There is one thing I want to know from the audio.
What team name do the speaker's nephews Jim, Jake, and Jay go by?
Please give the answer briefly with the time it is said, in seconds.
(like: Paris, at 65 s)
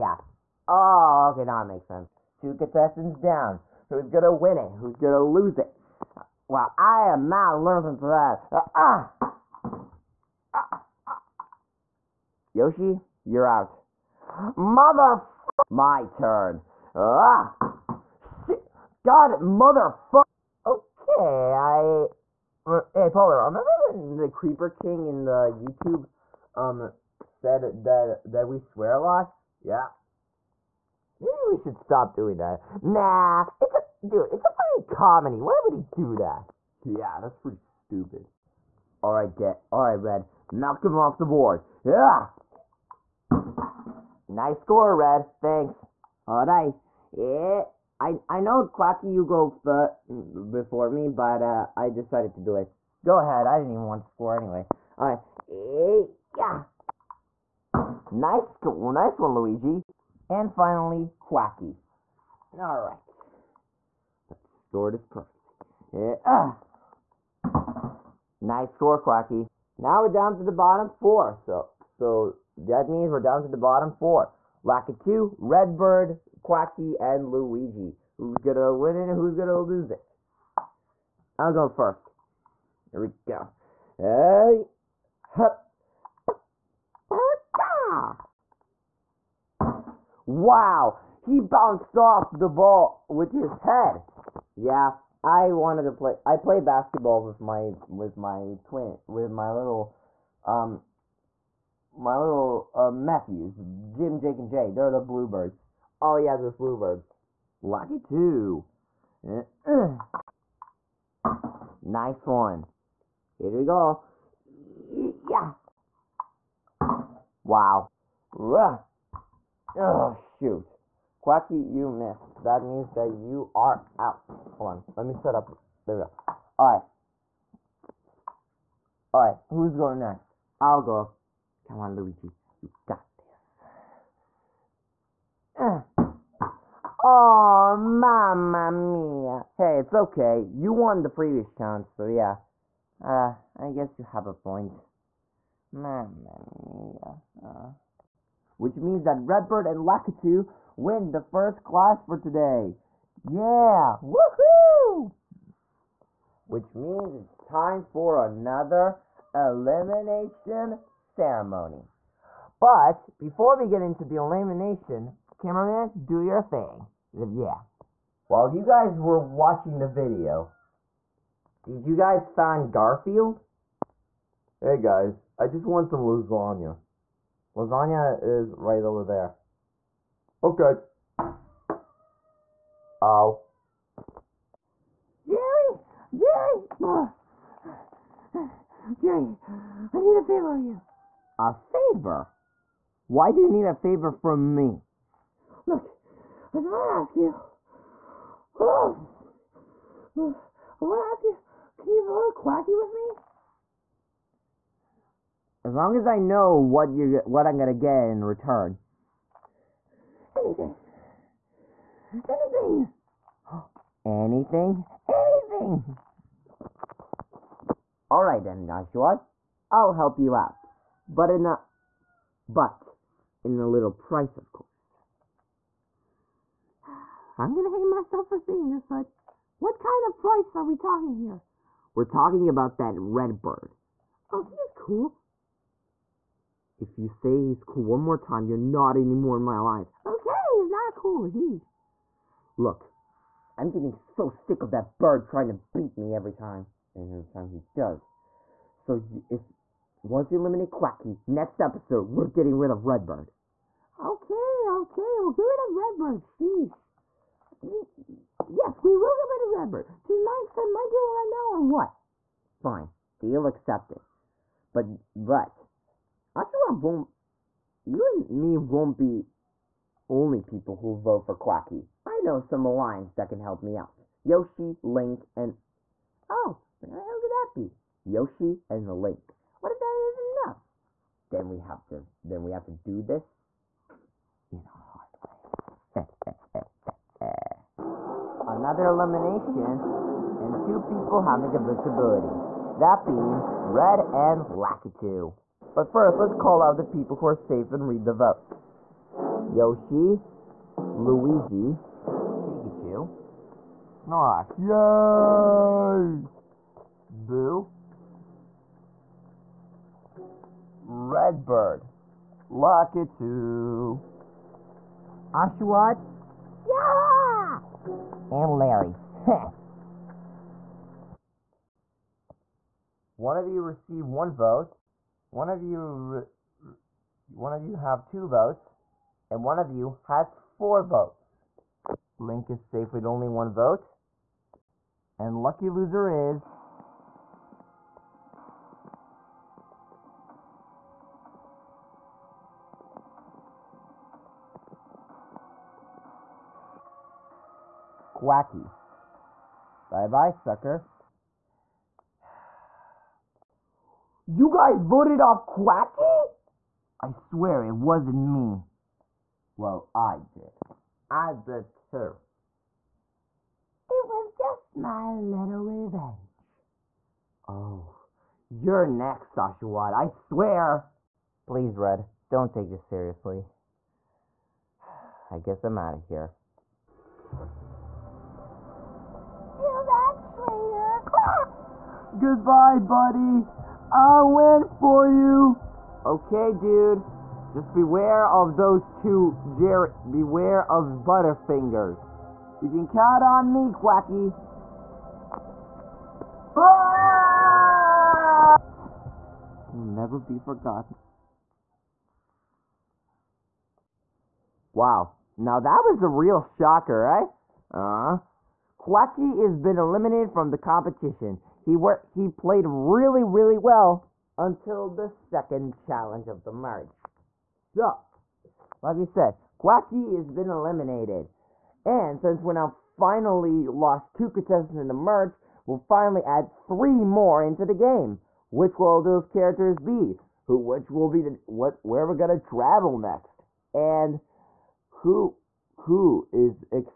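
The Bluebirds, at 104 s.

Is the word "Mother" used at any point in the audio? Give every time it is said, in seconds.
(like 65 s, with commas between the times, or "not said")
14 s, 19 s.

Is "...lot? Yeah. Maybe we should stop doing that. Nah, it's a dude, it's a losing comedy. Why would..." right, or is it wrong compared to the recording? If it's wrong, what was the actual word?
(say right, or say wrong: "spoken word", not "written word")
wrong: "freaking", not "losing".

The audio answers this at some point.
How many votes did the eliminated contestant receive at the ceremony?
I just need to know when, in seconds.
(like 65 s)
330 s.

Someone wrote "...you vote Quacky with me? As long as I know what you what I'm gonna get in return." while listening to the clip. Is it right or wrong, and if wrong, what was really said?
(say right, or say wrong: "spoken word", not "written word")
right.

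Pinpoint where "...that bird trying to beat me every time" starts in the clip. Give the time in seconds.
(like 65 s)
244 s.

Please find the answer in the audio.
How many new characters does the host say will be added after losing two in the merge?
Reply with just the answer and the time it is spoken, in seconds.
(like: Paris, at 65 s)
3, at 426 s.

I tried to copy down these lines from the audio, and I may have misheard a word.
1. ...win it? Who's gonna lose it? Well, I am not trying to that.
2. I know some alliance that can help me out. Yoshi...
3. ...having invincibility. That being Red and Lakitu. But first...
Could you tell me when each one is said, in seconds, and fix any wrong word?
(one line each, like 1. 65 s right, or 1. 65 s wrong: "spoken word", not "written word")
1. 4 s wrong: "losing", not "trying"
2. 272 s right
3. 291 s right.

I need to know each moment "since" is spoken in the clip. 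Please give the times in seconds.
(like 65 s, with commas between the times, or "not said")
422 s.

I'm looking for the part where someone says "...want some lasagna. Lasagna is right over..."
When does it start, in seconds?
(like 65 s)
175 s.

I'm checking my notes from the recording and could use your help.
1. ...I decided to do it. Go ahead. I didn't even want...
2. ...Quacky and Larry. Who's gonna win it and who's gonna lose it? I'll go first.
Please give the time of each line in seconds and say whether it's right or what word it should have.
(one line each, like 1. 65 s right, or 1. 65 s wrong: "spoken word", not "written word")
1. 51 s right
2. 76 s wrong: "Luigi", not "Larry".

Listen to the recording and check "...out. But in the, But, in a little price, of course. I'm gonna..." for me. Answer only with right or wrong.
right.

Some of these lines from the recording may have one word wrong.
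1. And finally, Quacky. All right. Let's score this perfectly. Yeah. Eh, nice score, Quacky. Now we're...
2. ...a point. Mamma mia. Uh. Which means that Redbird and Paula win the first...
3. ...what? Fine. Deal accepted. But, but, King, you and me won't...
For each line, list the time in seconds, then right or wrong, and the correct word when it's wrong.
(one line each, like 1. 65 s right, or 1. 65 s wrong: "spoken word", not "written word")
1. 60 s right
2. 144 s wrong: "Lakitu", not "Paula"
3. 261 s wrong: "Oshawott", not "King".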